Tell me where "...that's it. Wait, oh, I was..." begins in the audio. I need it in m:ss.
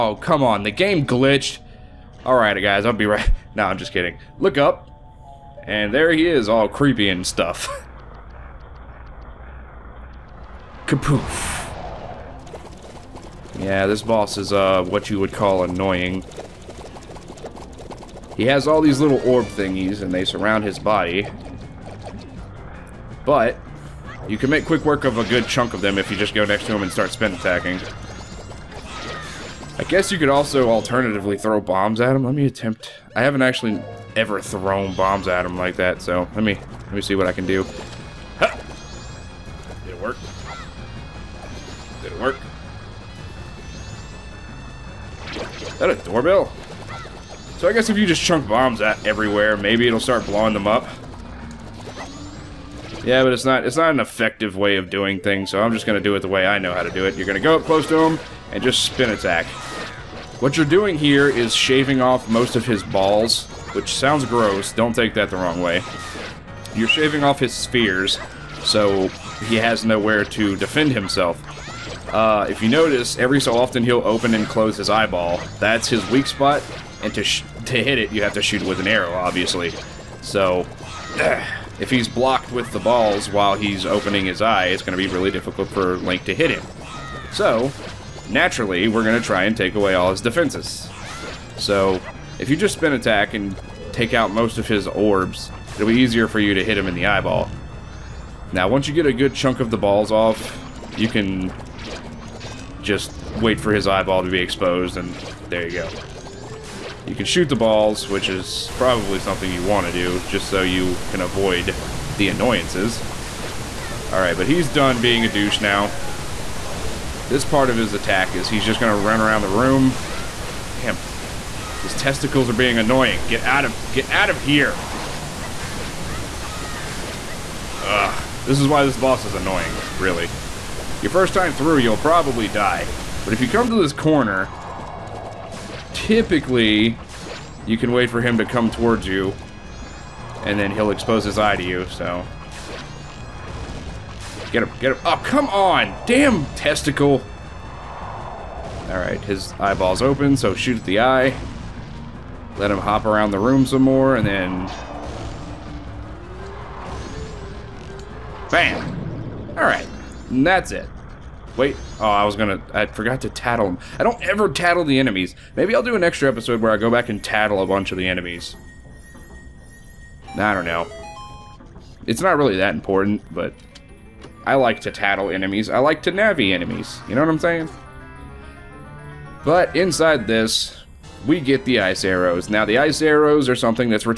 2:40.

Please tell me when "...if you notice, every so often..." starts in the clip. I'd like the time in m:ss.
1:12.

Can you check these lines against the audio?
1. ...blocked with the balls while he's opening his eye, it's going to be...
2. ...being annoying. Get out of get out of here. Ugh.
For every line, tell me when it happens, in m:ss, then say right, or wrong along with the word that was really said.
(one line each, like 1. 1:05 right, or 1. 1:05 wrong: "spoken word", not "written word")
1. 1:22 right
2. 2:02 right.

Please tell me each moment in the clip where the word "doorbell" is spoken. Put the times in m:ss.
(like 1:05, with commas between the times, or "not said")
0:45.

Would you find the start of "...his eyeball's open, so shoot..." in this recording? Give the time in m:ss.
2:29.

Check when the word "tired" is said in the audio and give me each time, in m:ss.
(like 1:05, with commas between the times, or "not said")
not said.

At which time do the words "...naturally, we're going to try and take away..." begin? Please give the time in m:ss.
1:28.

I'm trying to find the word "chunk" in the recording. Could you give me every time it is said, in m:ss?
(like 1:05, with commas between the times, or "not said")
0:25, 0:48, 1:39.